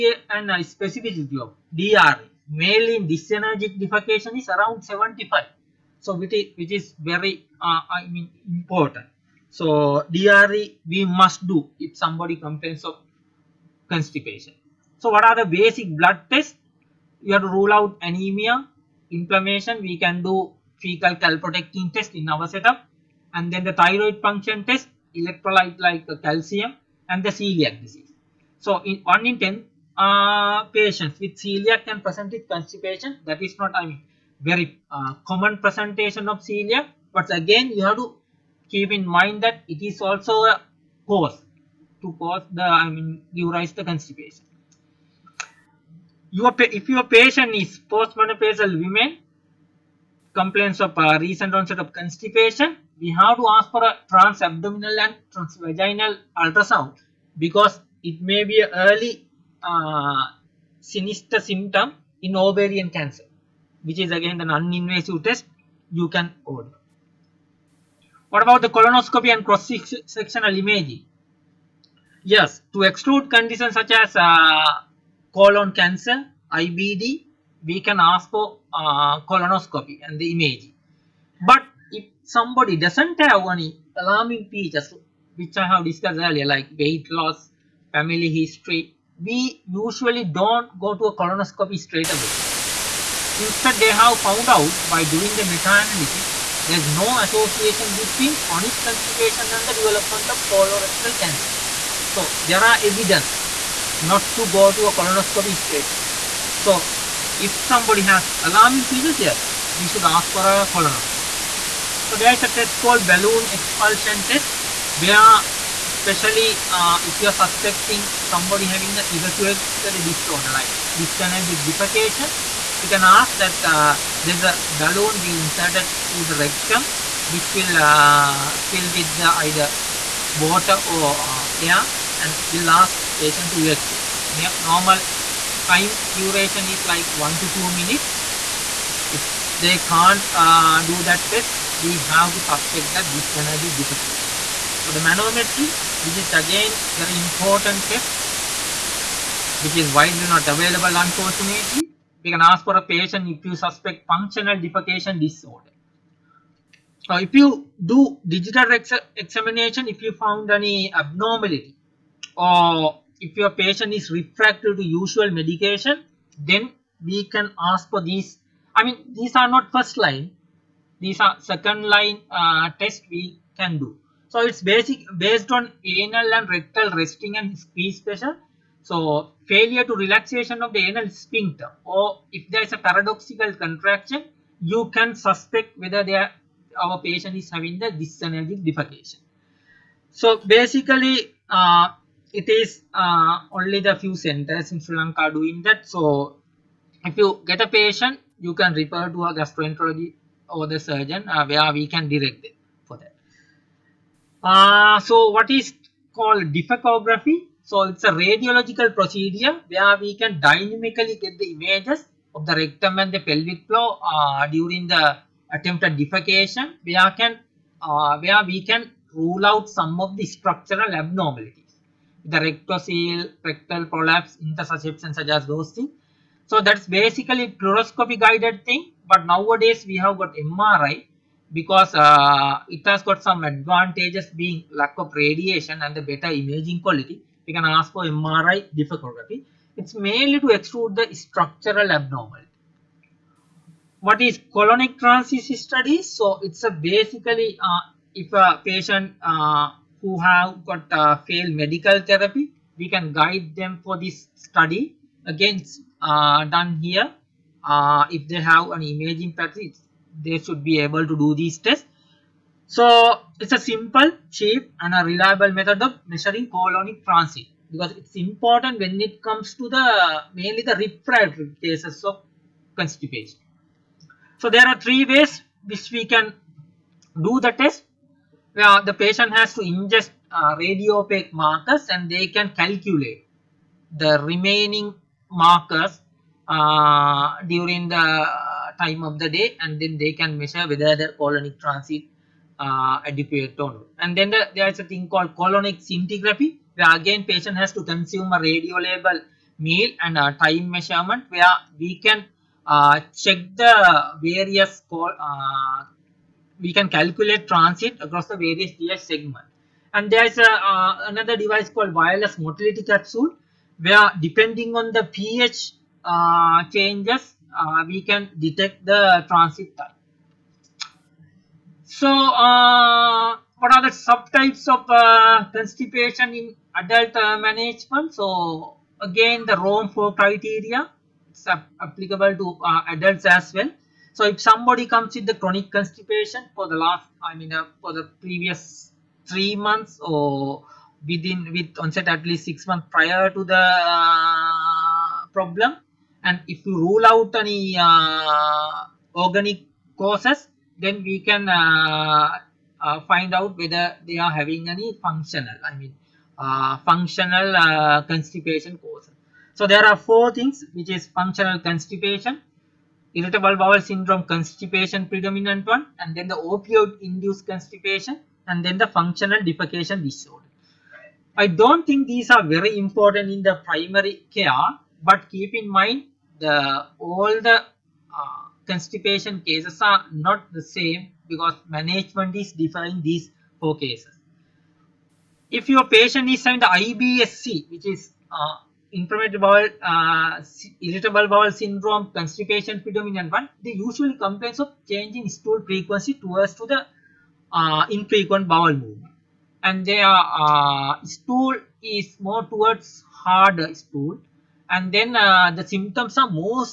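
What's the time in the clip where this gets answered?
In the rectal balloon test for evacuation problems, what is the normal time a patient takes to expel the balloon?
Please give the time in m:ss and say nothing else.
2:17.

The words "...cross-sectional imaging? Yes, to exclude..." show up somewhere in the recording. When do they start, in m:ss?
1:09.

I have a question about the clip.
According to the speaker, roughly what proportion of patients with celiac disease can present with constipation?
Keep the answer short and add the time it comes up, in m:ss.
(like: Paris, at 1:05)
1 in 10, at 0:29.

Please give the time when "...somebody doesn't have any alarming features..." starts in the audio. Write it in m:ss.
1:22.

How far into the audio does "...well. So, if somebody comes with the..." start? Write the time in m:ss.
5:33.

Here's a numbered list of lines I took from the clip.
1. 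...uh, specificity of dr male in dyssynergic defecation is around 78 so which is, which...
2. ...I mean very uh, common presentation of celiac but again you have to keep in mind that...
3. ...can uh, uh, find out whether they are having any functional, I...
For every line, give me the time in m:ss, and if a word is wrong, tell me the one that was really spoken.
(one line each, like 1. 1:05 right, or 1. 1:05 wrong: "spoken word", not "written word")
1. 0:00 wrong: "75", not "78"
2. 0:33 right
3. 5:51 right.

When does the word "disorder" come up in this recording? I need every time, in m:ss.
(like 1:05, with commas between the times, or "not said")
2:00, 2:35, 6:10.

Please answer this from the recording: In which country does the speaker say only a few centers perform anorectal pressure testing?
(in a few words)
Sri Lanka.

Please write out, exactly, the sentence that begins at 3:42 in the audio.
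The rectocele, rectal prolapse, intussusception such as those things.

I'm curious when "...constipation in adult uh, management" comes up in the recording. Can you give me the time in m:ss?
5:25.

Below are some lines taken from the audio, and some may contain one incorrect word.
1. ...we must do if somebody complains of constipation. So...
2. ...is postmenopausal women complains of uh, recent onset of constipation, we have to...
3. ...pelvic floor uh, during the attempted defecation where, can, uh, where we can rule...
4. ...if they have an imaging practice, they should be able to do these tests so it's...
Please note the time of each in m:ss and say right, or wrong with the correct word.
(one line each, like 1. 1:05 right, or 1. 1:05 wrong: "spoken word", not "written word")
1. 0:10 right
2. 0:47 right
3. 3:33 right
4. 4:18 right.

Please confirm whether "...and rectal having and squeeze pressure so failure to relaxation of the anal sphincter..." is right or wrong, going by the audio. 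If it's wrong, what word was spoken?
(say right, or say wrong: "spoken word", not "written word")
wrong: "resting", not "having".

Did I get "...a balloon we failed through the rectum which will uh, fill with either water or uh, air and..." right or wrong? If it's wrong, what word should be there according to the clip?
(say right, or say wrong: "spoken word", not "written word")
wrong: "inserted", not "failed".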